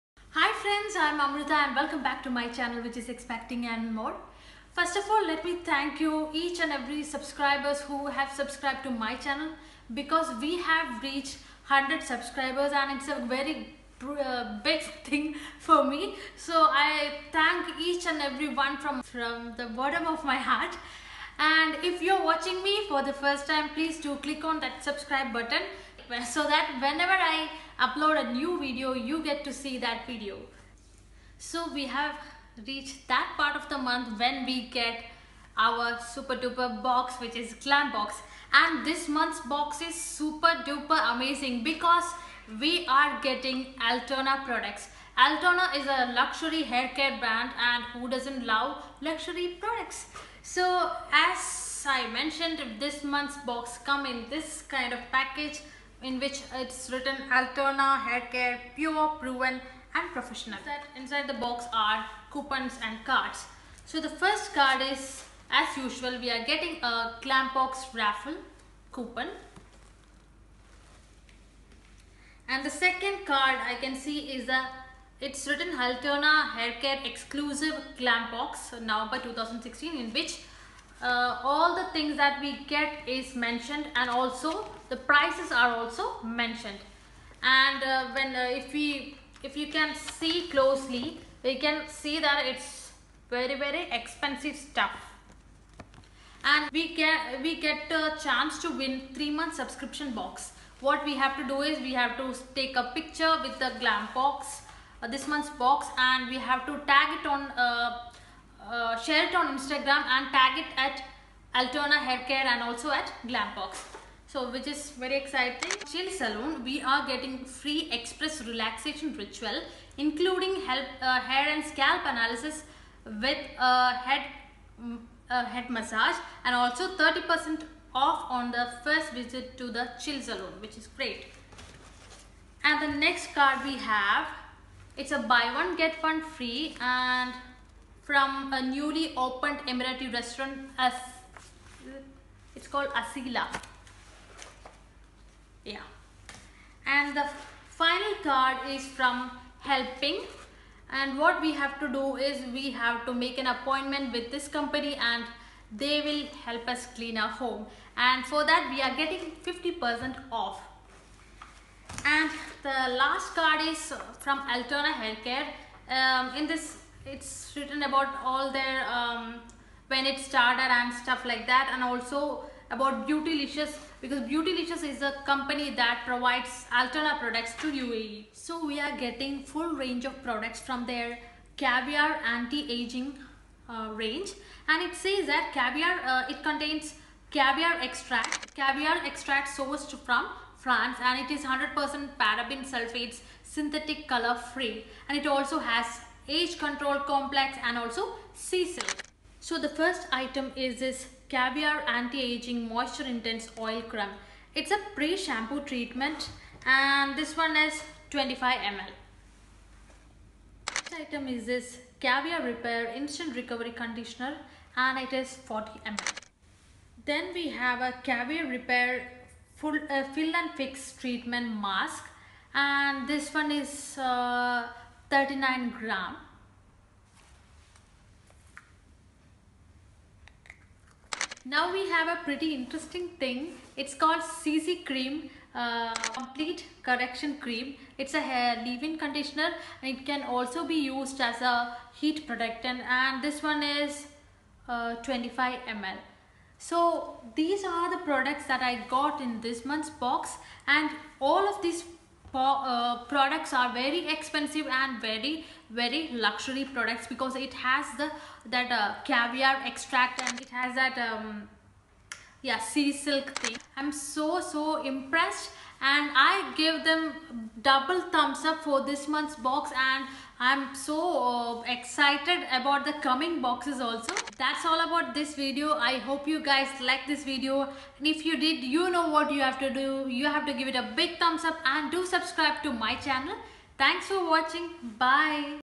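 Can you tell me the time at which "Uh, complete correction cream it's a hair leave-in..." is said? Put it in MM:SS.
03:55.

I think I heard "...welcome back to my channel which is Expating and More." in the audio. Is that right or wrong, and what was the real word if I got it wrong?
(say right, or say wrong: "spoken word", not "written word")
right.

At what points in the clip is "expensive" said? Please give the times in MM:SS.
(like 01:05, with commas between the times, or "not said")
01:33, 04:14.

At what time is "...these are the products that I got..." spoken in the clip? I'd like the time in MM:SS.
04:07.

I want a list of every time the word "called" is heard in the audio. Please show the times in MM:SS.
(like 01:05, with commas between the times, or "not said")
02:22, 03:53.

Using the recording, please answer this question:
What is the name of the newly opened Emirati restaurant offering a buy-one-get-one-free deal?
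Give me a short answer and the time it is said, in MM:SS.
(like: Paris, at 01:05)
Asila, at 02:23.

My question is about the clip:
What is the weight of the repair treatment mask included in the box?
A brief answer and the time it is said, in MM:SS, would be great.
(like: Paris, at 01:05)
39 grams, at 03:45.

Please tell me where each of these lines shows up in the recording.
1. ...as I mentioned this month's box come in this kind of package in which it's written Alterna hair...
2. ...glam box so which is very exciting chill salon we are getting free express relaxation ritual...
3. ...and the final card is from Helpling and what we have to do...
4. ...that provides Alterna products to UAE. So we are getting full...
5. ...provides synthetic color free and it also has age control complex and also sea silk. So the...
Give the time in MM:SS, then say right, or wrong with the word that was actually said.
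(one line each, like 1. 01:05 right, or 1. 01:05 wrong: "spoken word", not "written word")
1. 00:51 right
2. 01:53 right
3. 02:26 right
4. 02:55 right
5. 03:12 wrong: "sulfates", not "provides".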